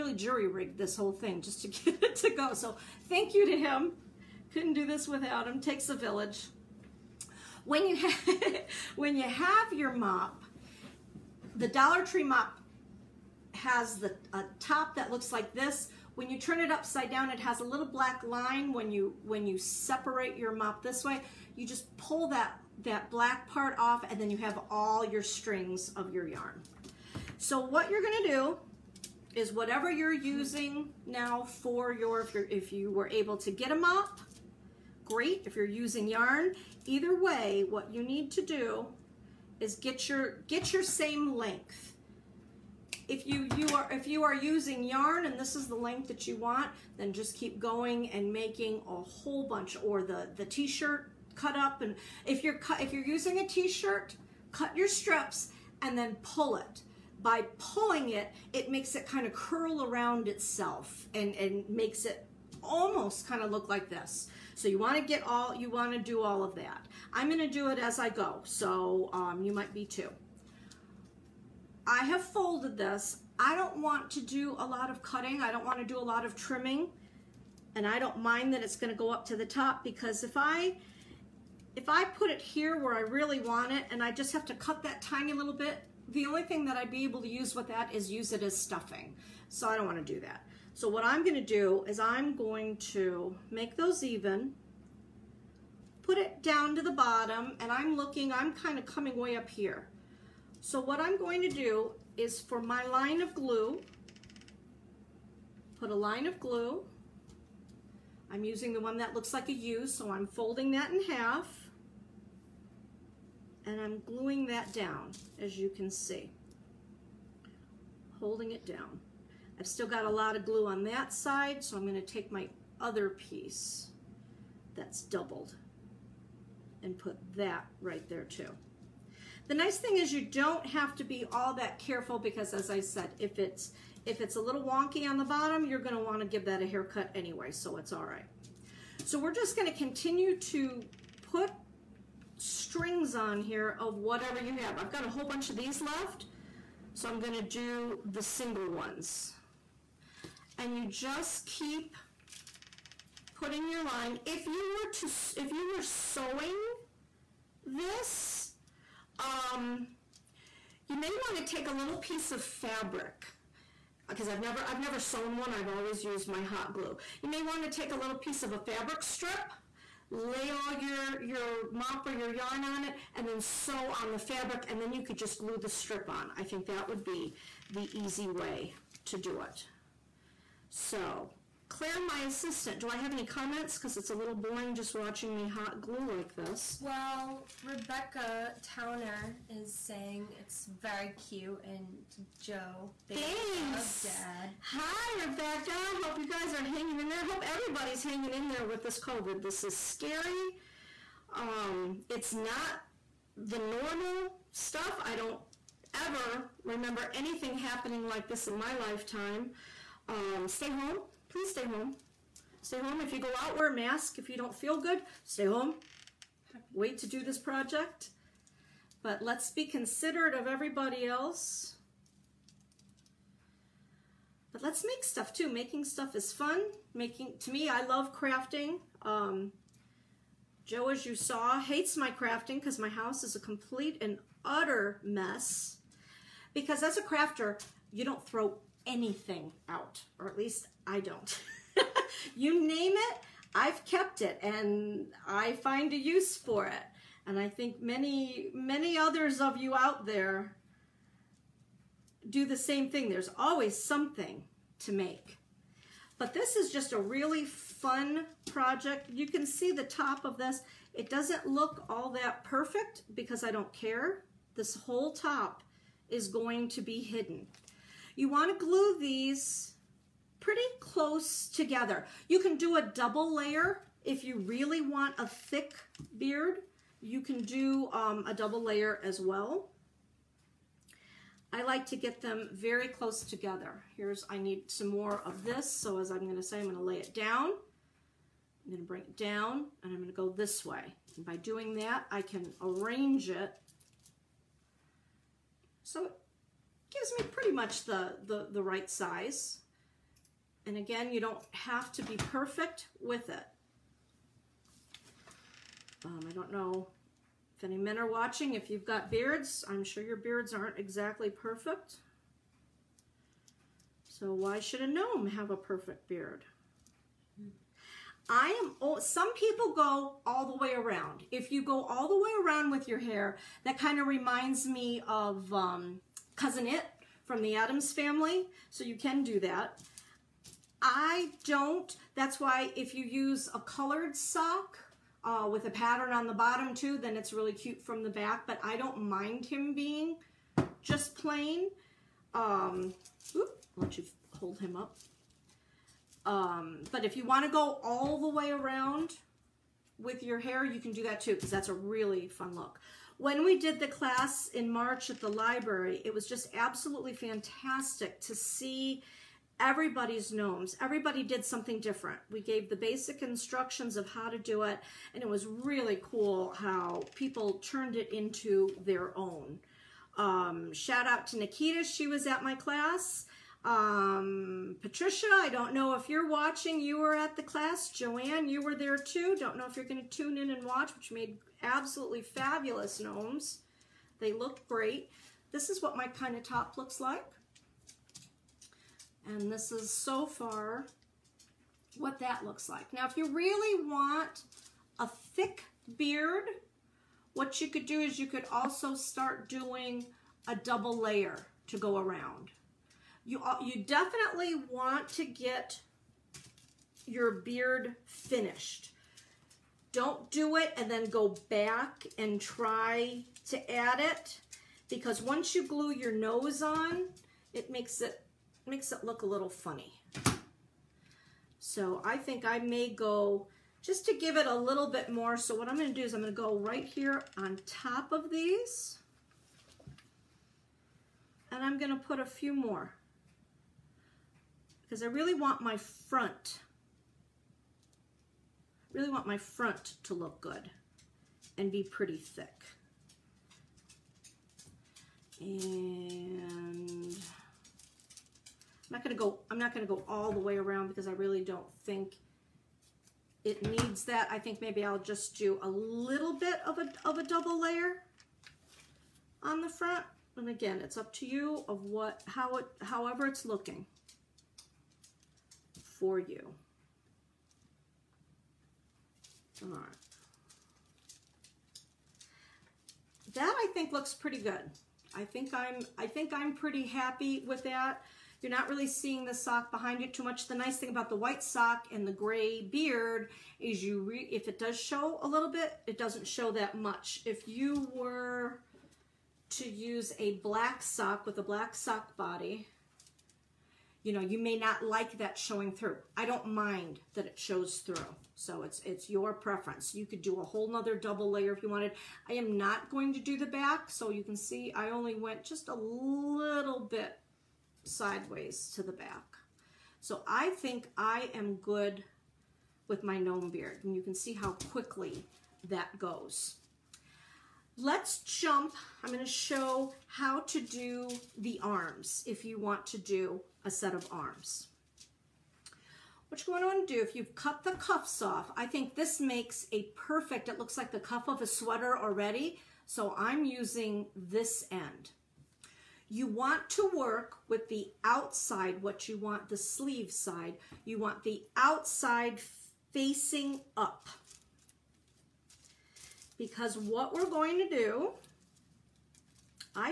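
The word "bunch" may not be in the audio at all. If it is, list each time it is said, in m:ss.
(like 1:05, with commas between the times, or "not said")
0:49, 2:25.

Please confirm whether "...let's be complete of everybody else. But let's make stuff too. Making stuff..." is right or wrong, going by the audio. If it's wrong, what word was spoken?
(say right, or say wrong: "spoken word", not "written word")
wrong: "considerate", not "complete".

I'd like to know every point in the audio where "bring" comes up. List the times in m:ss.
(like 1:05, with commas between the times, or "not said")
4:48.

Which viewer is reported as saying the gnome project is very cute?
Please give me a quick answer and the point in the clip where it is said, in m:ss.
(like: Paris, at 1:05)
Rebecca Towner, at 3:07.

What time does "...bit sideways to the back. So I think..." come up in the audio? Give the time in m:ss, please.
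8:26.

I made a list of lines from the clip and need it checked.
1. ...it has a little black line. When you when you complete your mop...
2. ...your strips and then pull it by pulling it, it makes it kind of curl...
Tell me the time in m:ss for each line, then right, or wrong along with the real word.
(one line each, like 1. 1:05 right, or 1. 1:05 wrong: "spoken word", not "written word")
1. 0:17 wrong: "separate", not "complete"
2. 0:54 right.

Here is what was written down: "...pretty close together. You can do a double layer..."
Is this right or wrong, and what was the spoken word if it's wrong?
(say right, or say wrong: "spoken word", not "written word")
right.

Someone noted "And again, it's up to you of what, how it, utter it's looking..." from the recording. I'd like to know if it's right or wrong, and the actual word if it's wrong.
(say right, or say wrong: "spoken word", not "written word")
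wrong: "however", not "utter".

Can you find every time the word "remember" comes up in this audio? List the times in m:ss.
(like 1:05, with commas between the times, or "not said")
3:26.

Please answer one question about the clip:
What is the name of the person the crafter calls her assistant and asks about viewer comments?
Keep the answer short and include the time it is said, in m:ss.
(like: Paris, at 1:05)
Claire, at 3:01.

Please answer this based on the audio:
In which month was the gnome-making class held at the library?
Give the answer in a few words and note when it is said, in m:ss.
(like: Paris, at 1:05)
March, at 5:54.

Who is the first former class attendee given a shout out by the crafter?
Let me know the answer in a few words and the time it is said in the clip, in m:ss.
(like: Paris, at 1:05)
Nikita, at 6:11.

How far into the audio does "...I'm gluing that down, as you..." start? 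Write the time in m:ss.
1:53.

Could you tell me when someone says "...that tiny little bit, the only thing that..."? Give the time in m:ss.
1:24.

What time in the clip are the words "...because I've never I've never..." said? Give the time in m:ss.
2:44.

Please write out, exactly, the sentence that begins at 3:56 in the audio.
Because as a crafter, you don't throw anything out, or at least I don't.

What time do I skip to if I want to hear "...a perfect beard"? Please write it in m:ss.
5:15.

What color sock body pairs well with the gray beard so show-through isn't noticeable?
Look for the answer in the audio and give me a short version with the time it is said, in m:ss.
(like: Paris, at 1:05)
white, at 8:01.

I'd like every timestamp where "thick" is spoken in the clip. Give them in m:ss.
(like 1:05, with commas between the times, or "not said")
4:35, 6:35, 7:22.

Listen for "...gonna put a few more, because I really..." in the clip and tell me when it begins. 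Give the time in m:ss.
7:11.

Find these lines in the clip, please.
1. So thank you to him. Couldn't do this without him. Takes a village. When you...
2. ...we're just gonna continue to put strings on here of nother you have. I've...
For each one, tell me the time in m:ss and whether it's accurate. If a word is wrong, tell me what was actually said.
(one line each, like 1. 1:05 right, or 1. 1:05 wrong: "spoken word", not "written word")
1. 0:02 right
2. 2:19 wrong: "whatever", not "nother".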